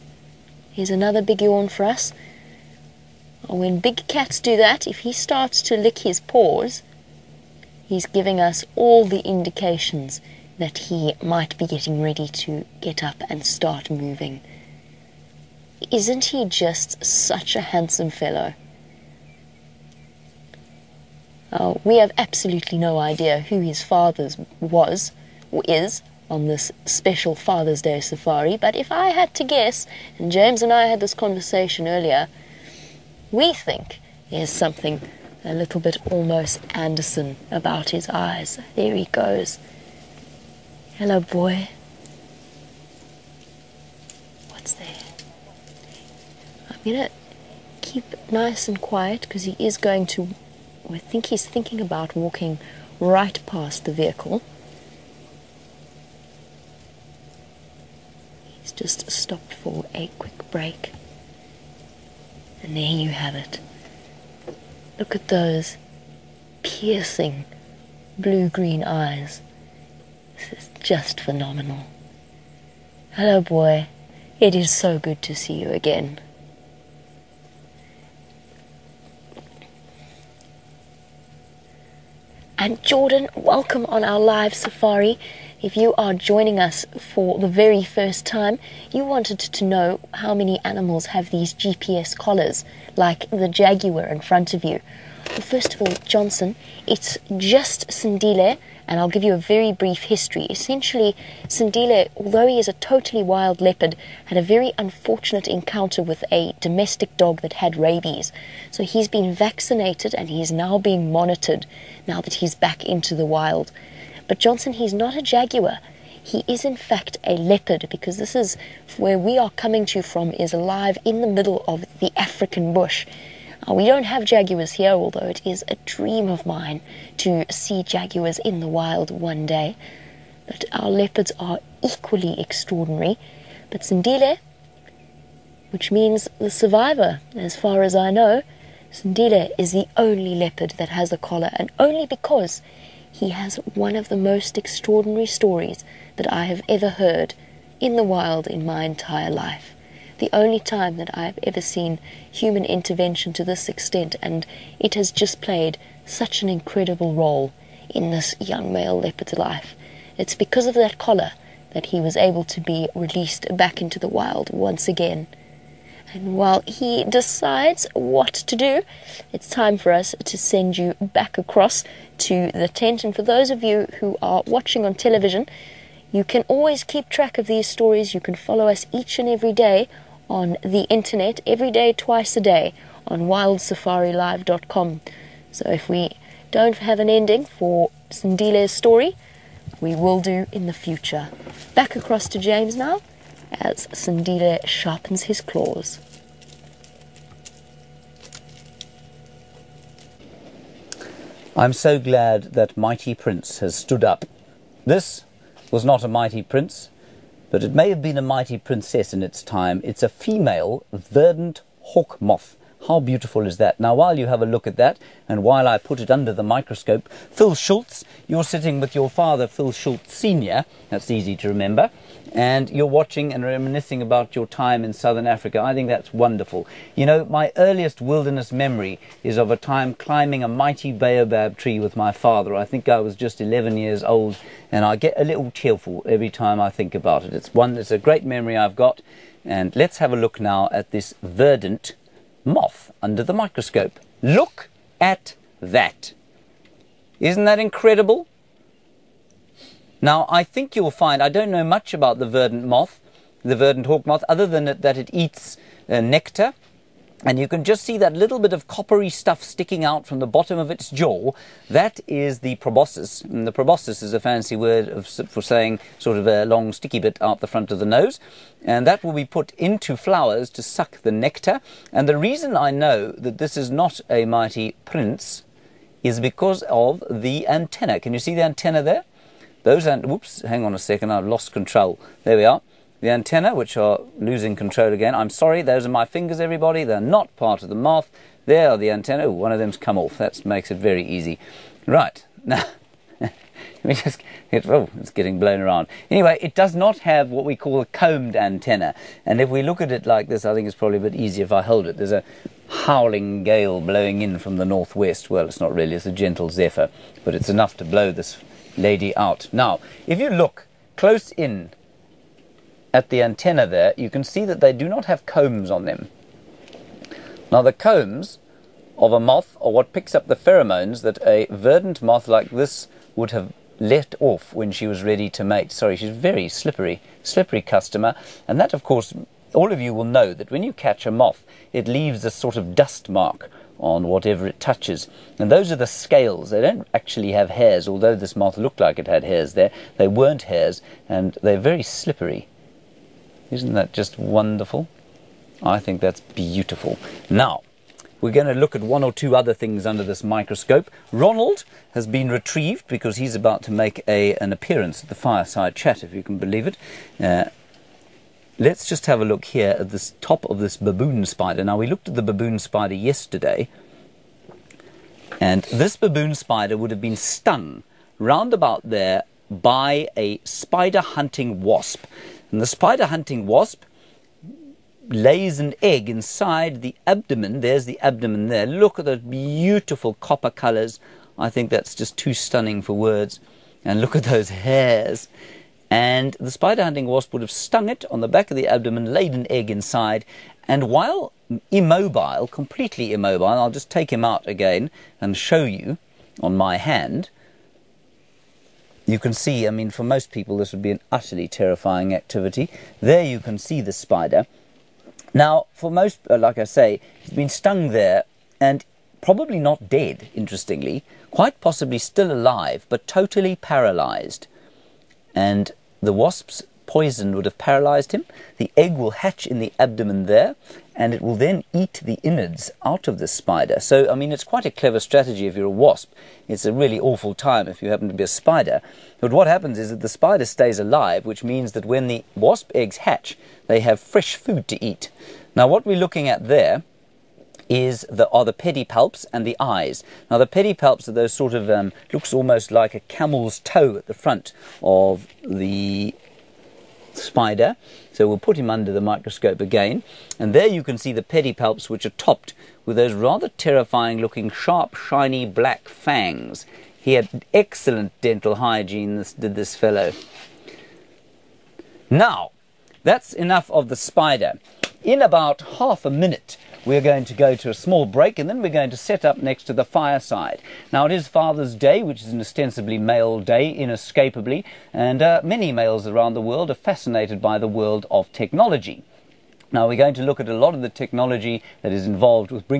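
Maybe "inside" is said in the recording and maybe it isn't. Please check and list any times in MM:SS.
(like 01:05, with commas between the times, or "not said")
06:16, 06:29.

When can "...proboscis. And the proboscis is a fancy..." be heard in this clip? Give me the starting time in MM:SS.
04:22.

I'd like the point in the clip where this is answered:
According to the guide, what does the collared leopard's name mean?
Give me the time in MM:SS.
02:16.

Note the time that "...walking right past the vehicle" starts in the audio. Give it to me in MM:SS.
00:52.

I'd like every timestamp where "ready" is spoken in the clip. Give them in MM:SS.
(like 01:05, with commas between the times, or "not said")
00:12, 05:25.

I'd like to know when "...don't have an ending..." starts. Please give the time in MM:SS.
03:06.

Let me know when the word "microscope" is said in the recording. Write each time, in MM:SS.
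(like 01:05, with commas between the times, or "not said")
03:36, 04:03, 05:50, 07:29.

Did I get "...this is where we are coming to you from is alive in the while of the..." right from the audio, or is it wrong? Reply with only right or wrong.
wrong.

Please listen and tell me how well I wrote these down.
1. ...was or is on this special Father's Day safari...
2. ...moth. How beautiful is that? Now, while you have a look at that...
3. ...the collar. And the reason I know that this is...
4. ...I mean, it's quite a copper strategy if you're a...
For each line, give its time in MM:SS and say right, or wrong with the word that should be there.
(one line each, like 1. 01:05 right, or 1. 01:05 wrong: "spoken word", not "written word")
1. 00:24 right
2. 03:32 right
3. 04:31 wrong: "nectar", not "collar"
4. 07:04 wrong: "clever", not "copper".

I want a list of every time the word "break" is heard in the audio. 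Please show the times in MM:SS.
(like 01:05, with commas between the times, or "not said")
01:00, 07:48.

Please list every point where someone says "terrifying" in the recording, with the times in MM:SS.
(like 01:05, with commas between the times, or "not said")
06:41, 07:33.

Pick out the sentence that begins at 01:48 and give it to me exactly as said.
So he's been vaccinated and he's now being monitored now that he's back into the wild.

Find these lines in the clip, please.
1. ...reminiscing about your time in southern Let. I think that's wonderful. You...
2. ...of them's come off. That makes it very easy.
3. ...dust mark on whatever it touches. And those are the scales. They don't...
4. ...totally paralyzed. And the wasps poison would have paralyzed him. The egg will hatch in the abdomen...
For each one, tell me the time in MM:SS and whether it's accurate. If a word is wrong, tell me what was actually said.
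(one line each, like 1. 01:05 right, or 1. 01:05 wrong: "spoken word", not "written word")
1. 03:43 wrong: "Africa", not "Let"
2. 04:49 right
3. 05:32 right
4. 06:53 right.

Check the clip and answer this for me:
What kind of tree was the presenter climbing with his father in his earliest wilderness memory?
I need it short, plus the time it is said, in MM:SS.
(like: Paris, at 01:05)
Baobab, at 03:50.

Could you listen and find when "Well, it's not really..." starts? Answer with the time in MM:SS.
05:05.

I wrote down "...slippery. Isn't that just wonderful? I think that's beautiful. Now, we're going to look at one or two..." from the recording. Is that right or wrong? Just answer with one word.
right.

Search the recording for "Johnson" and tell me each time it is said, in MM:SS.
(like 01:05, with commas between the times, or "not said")
01:36, 01:54.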